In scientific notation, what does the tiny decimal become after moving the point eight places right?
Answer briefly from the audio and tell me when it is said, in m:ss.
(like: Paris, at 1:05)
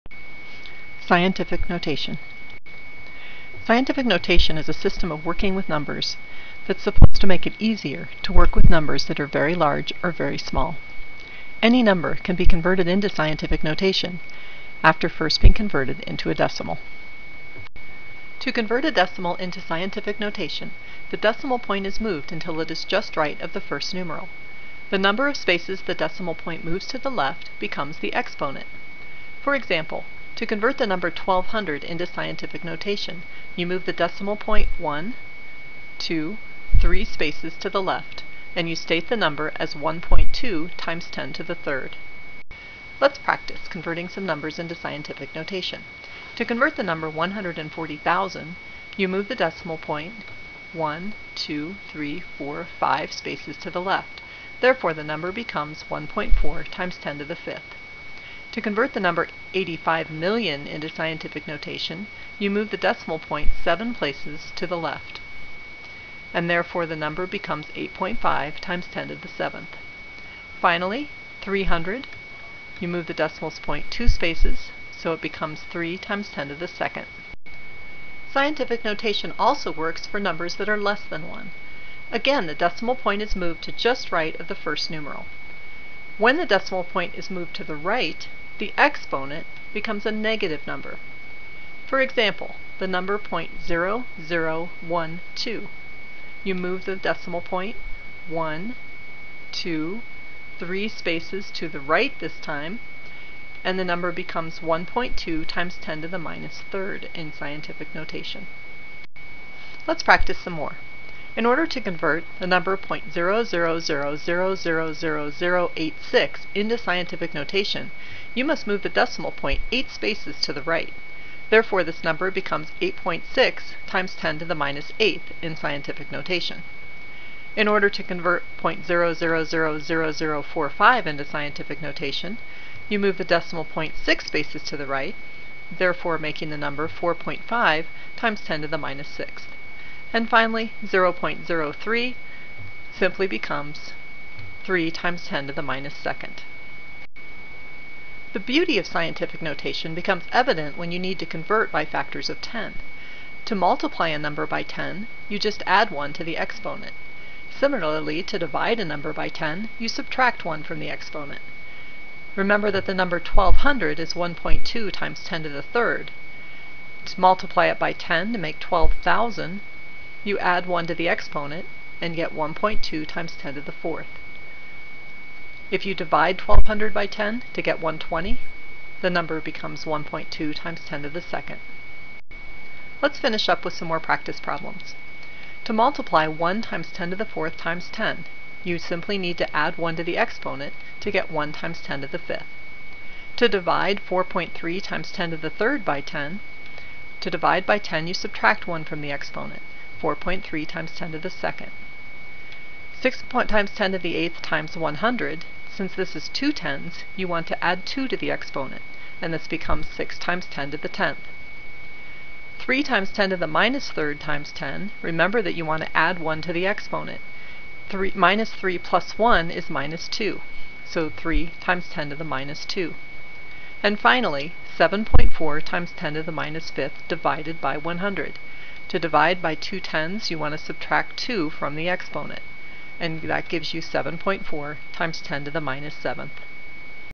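8.6 × 10^-8, at 2:02.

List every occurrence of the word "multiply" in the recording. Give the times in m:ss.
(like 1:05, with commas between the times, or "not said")
2:33, 2:47, 3:05.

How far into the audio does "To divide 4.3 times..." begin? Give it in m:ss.
3:13.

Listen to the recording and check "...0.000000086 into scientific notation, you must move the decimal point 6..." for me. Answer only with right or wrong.
wrong.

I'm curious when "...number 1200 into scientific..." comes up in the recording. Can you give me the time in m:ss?
0:30.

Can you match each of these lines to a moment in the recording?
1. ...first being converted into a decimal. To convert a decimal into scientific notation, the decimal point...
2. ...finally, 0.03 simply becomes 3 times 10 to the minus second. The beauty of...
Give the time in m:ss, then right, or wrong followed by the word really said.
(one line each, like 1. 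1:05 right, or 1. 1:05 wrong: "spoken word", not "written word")
1. 0:15 right
2. 2:20 right.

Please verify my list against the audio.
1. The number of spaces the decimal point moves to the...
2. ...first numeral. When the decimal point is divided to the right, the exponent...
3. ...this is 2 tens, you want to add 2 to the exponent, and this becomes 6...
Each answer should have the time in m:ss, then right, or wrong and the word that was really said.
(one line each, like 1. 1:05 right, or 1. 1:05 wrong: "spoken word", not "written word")
1. 0:24 right
2. 1:24 wrong: "moved", not "divided"
3. 3:25 right.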